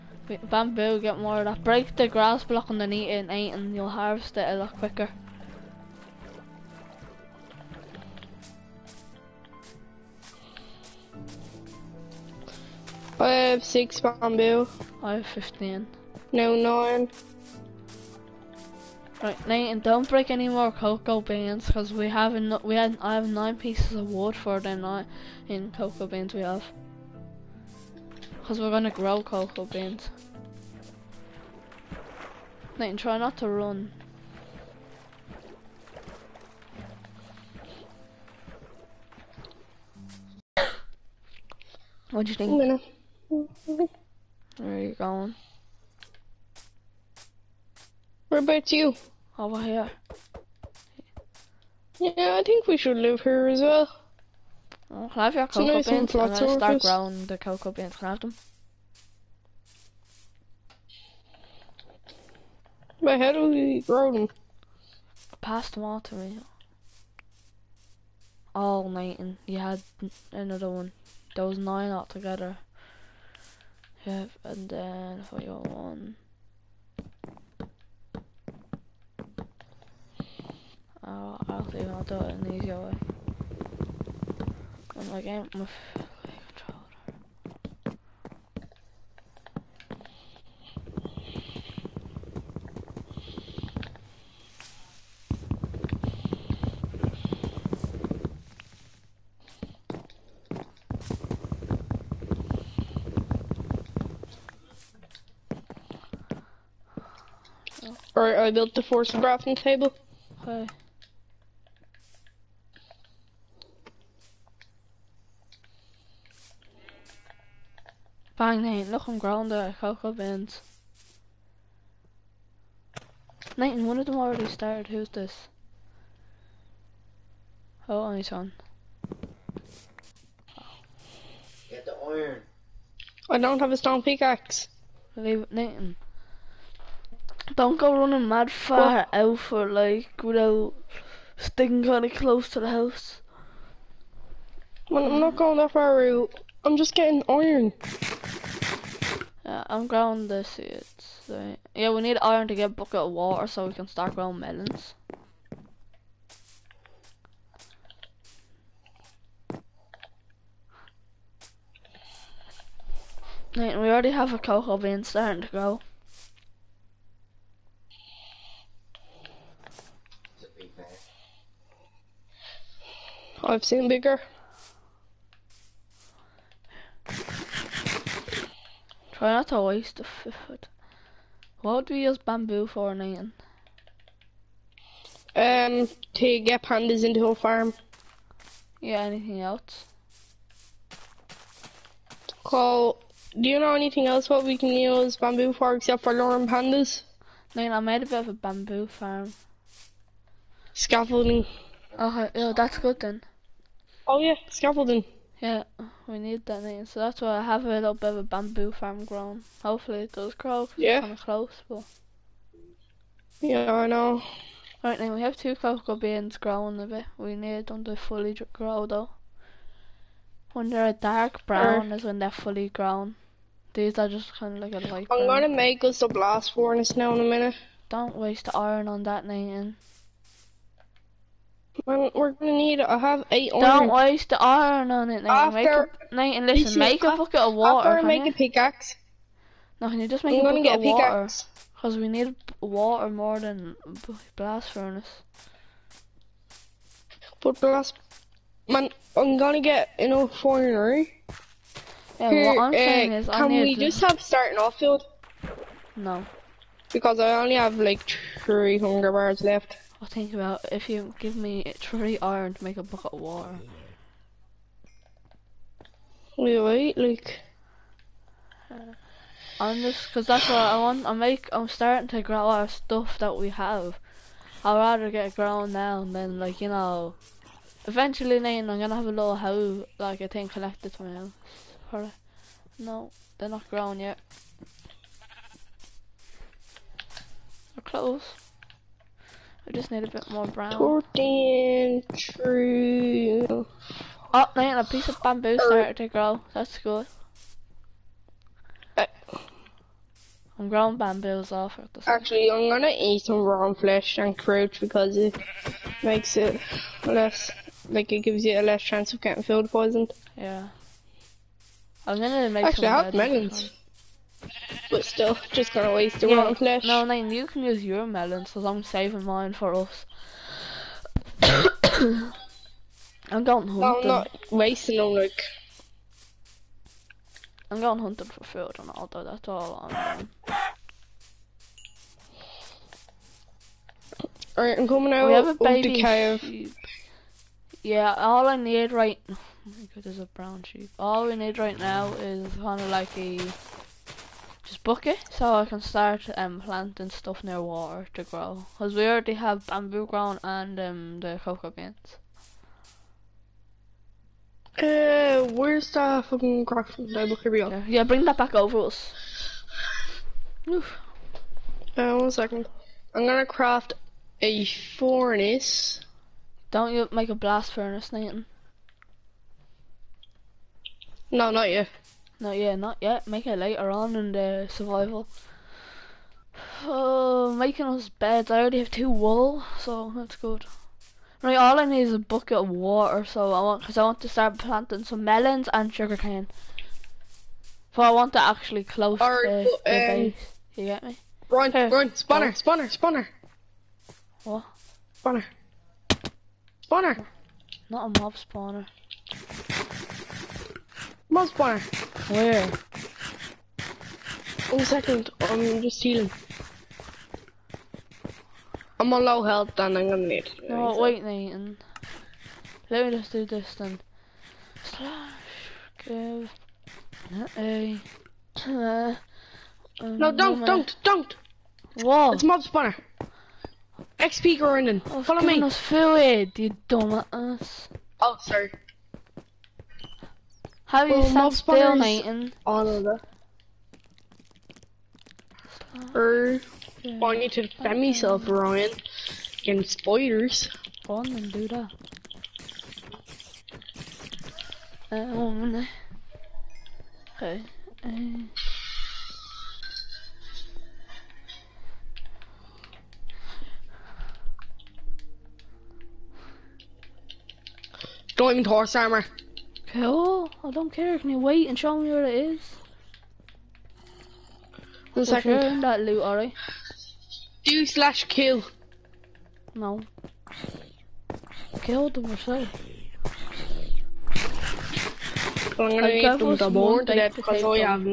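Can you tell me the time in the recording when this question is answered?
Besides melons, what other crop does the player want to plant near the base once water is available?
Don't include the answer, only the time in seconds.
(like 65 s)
385 s.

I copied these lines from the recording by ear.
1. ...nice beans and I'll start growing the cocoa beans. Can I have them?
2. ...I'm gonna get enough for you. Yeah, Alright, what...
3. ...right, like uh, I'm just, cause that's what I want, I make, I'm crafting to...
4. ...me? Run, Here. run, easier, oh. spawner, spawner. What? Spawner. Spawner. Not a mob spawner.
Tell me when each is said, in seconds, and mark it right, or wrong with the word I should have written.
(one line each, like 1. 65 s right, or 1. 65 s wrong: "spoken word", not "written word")
1. 55 s right
2. 249 s wrong: "Here", not "Alright"
3. 266 s wrong: "starting", not "crafting"
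4. 391 s wrong: "spawner", not "easier".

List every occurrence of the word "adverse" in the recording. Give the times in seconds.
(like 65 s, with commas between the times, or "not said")
not said.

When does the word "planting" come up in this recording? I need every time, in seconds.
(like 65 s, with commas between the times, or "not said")
346 s, 384 s.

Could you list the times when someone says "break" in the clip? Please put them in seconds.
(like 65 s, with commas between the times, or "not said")
1 s, 20 s.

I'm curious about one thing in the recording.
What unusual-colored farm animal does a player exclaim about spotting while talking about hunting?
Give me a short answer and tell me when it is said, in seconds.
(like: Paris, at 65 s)
Brown sheep, at 340 s.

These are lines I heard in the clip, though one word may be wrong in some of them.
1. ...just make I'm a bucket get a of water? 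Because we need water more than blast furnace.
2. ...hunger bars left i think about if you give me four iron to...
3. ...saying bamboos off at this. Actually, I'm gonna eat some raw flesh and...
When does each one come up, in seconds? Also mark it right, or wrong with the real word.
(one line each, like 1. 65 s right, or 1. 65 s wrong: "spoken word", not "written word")
1. 240 s right
2. 258 s wrong: "three", not "four"
3. 300 s wrong: "growing", not "saying".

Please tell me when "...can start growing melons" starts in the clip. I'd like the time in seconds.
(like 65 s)
153 s.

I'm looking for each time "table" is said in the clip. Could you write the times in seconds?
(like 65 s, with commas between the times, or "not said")
109 s, 357 s.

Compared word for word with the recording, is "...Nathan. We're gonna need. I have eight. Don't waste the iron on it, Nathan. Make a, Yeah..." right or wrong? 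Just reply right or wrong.
wrong.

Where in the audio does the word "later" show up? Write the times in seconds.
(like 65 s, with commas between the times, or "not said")
373 s.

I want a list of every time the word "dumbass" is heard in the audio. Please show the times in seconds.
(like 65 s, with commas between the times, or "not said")
426 s.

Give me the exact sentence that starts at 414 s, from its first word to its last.
Slash, give, a, uh, No, um, don't, don't, don't!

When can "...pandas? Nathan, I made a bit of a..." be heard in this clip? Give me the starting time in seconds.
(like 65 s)
196 s.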